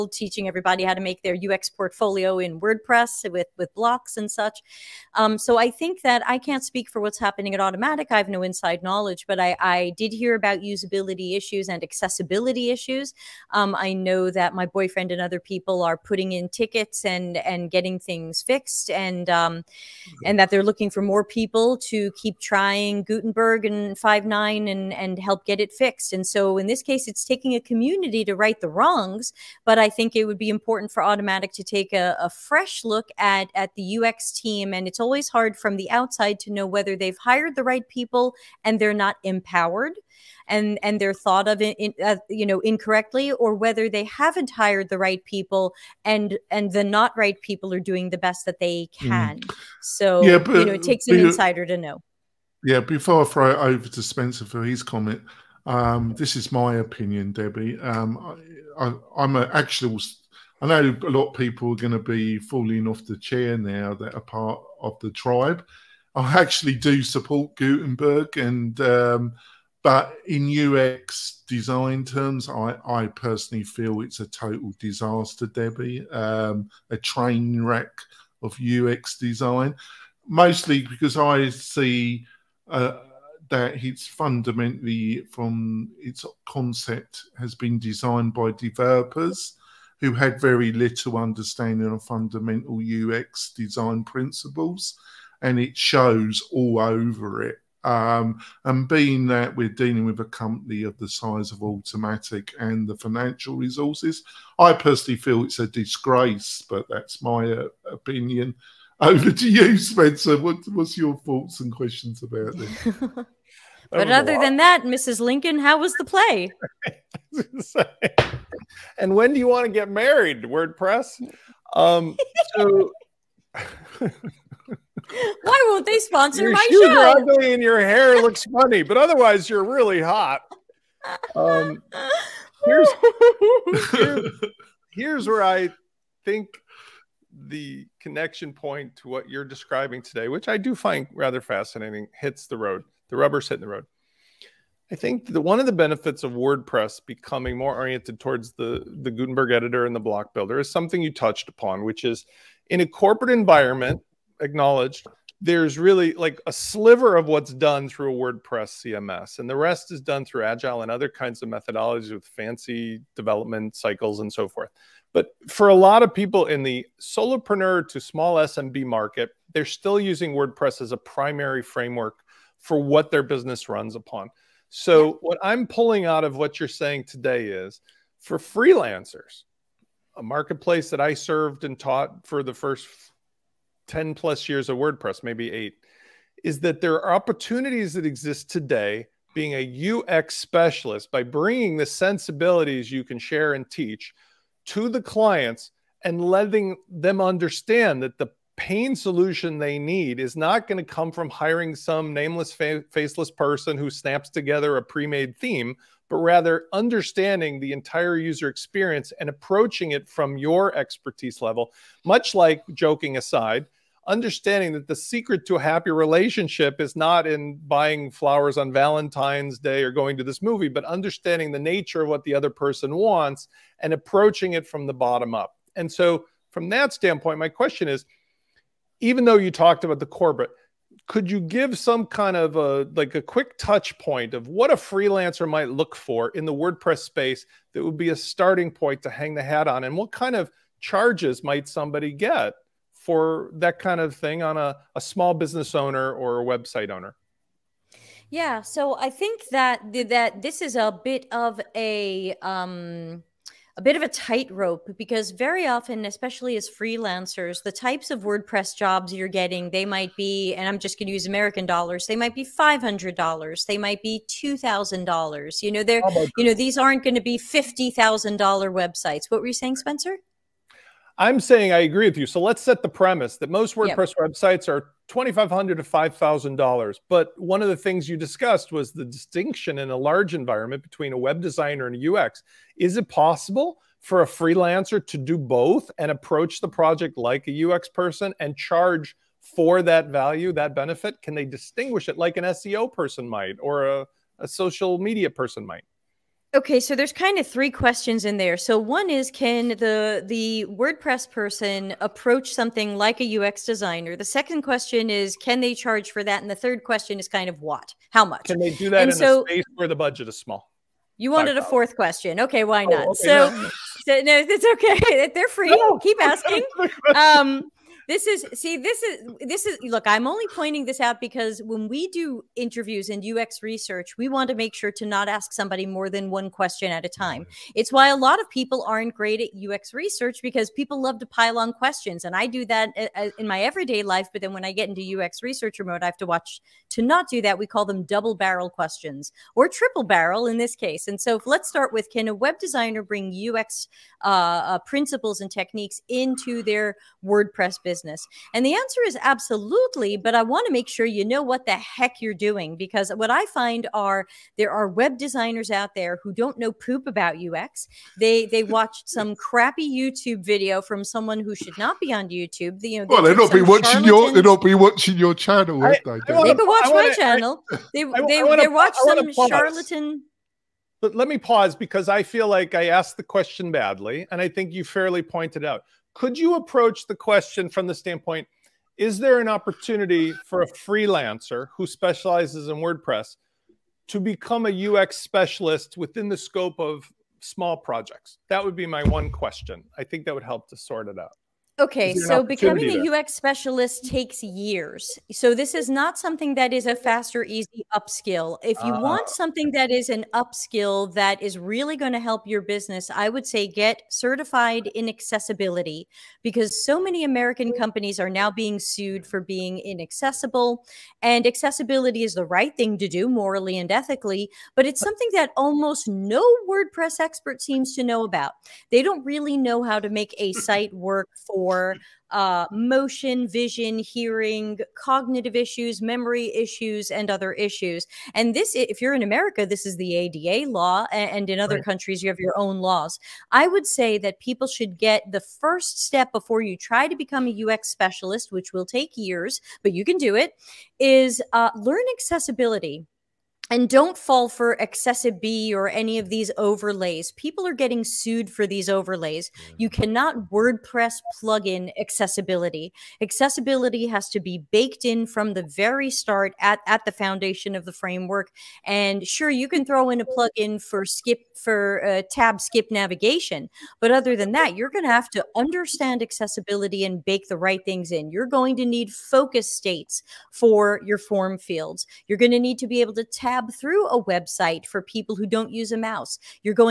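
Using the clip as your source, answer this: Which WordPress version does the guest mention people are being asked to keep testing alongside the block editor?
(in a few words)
5.9.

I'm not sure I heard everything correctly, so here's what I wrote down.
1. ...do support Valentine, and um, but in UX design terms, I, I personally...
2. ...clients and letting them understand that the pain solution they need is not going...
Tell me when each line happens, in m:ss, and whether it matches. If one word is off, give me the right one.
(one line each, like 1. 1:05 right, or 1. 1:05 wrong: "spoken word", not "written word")
1. 1:06 wrong: "Gutenberg", not "Valentine"
2. 3:15 right.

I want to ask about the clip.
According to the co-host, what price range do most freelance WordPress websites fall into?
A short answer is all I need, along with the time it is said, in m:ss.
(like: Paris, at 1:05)
$2,500 to $5,000, at 4:35.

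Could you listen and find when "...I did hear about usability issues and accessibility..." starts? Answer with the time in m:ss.
0:09.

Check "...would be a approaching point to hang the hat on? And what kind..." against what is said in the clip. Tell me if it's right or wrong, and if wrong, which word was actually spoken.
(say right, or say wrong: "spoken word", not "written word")
wrong: "starting", not "approaching".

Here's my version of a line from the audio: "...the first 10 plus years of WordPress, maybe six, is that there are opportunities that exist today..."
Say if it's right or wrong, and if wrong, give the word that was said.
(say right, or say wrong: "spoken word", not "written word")
wrong: "eight", not "six".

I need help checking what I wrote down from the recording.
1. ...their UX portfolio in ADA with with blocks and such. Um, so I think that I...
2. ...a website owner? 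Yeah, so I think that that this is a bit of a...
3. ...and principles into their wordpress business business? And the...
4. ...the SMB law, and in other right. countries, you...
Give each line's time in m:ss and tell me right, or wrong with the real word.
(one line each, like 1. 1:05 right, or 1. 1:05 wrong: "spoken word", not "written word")
1. 0:01 wrong: "WordPress", not "ADA"
2. 4:06 right
3. 5:45 wrong: "techniques", not "principles"
4. 7:09 wrong: "ADA", not "SMB".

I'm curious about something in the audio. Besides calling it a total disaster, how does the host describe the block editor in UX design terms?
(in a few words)
A train wreck.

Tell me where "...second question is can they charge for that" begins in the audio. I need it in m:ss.
5:04.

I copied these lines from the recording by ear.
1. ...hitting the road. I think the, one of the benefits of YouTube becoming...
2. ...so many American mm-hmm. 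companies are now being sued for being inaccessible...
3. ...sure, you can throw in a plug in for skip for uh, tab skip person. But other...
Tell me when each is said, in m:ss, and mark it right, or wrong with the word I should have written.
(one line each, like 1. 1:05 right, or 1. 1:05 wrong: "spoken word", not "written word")
1. 2:23 wrong: "WordPress", not "YouTube"
2. 6:46 right
3. 7:39 wrong: "navigation", not "person".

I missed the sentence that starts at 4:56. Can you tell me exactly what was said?
Okay, so there's kind of three questions in there.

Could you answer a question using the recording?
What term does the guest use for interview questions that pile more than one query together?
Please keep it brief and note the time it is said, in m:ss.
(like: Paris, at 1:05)
Double barrel questions, at 5:38.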